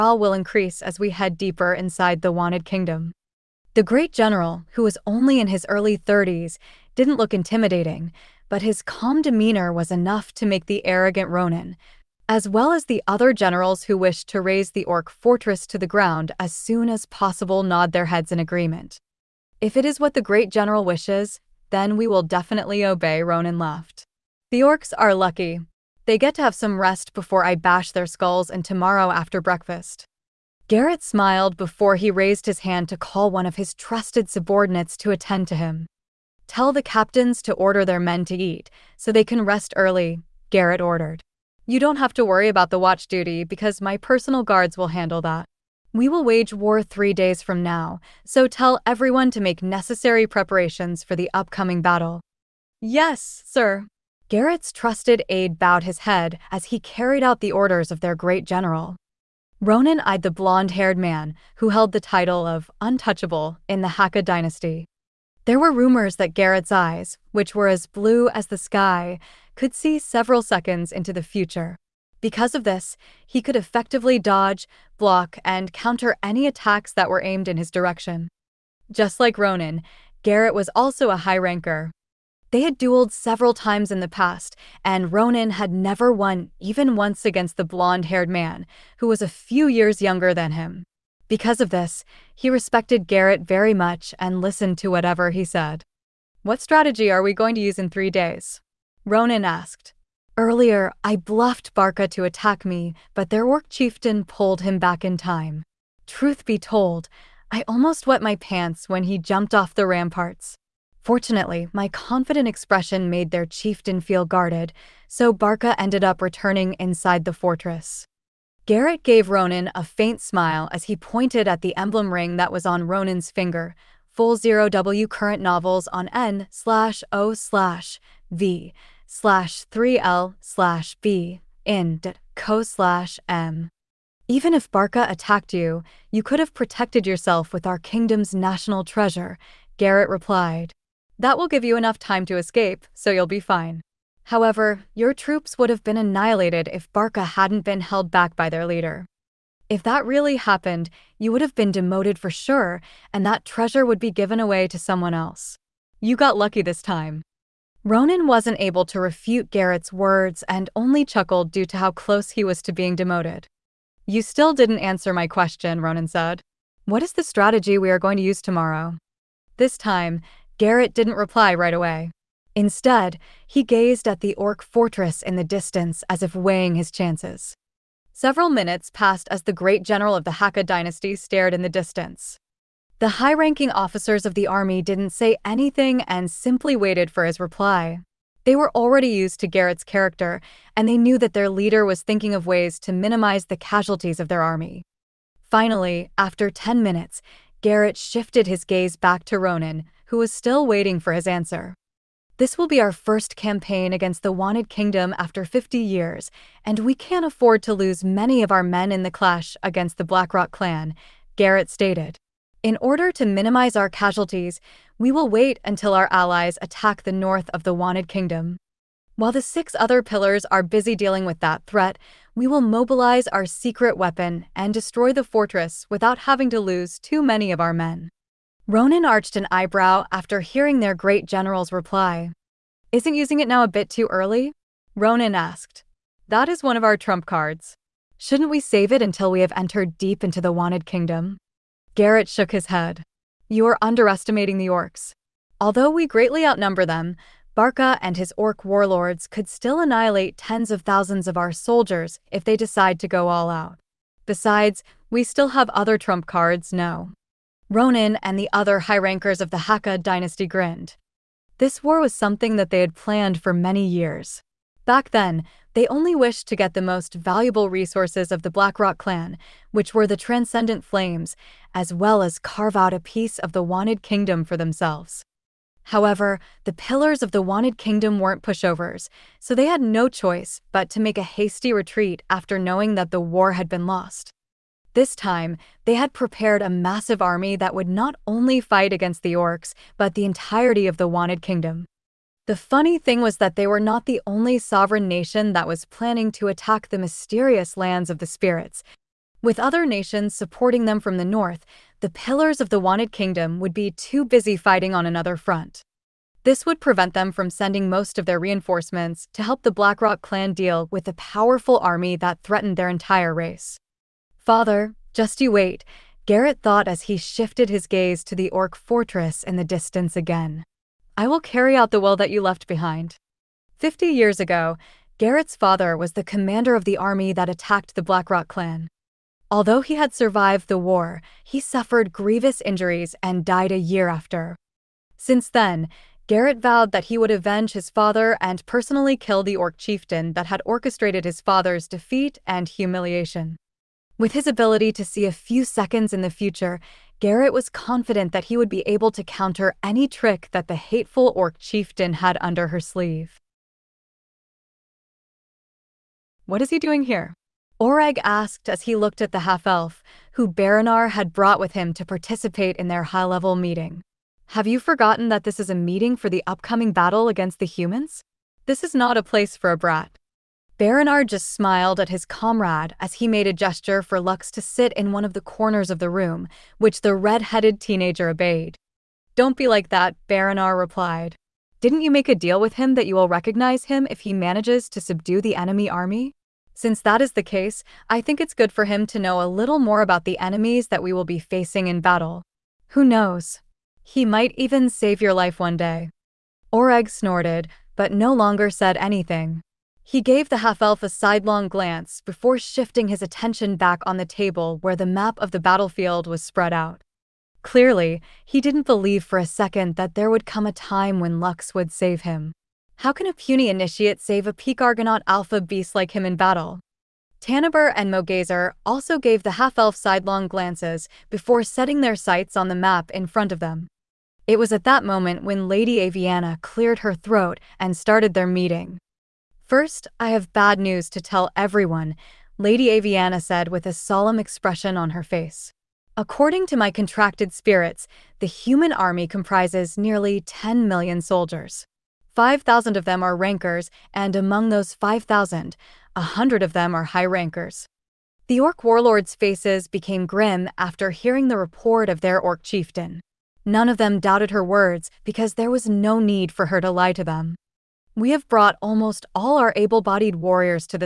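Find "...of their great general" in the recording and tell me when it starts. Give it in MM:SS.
00:57.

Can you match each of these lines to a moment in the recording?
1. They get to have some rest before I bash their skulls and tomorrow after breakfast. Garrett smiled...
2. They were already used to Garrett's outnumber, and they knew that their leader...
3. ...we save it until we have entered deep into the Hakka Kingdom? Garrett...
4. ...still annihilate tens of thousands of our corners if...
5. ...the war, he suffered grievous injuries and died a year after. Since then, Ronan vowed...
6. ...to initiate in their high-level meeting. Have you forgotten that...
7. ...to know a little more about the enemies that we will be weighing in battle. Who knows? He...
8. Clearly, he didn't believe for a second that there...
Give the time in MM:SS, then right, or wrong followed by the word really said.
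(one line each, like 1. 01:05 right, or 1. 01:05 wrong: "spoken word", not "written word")
1. 00:26 right
2. 03:08 wrong: "character", not "outnumber"
3. 03:58 wrong: "Wanted", not "Hakka"
4. 04:09 wrong: "soldiers", not "corners"
5. 05:30 wrong: "Garrett", not "Ronan"
6. 06:01 wrong: "participate", not "initiate"
7. 06:29 wrong: "facing", not "weighing"
8. 06:47 right.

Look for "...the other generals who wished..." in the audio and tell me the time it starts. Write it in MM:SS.
00:12.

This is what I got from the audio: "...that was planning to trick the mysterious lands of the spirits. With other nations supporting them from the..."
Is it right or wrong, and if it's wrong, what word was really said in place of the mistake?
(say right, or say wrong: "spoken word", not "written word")
wrong: "attack", not "trick".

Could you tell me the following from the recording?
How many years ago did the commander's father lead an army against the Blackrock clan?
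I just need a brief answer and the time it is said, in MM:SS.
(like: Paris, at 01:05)
50, at 05:23.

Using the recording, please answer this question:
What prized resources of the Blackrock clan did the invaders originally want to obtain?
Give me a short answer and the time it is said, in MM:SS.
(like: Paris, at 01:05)
Transcendent Flames, at 04:30.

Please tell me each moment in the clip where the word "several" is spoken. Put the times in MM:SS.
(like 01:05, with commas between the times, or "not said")
01:09, 01:23, 02:58.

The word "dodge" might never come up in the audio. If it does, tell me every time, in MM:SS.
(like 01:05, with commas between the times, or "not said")
01:14.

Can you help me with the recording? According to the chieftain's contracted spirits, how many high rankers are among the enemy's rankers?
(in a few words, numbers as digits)
100.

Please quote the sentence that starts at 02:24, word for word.
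However, your troops would have been annihilated if Barca hadn't been held back by their leader.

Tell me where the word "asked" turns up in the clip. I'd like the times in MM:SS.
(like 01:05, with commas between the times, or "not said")
01:39, 03:55, 05:58.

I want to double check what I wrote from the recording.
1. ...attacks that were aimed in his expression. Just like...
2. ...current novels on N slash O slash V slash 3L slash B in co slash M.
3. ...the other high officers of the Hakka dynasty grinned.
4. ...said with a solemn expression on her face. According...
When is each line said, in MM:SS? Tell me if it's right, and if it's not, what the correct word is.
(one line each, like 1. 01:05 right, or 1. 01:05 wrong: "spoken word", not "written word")
1. 01:16 wrong: "direction", not "expression"
2. 02:05 right
3. 04:18 wrong: "rankers", not "officers"
4. 07:13 right.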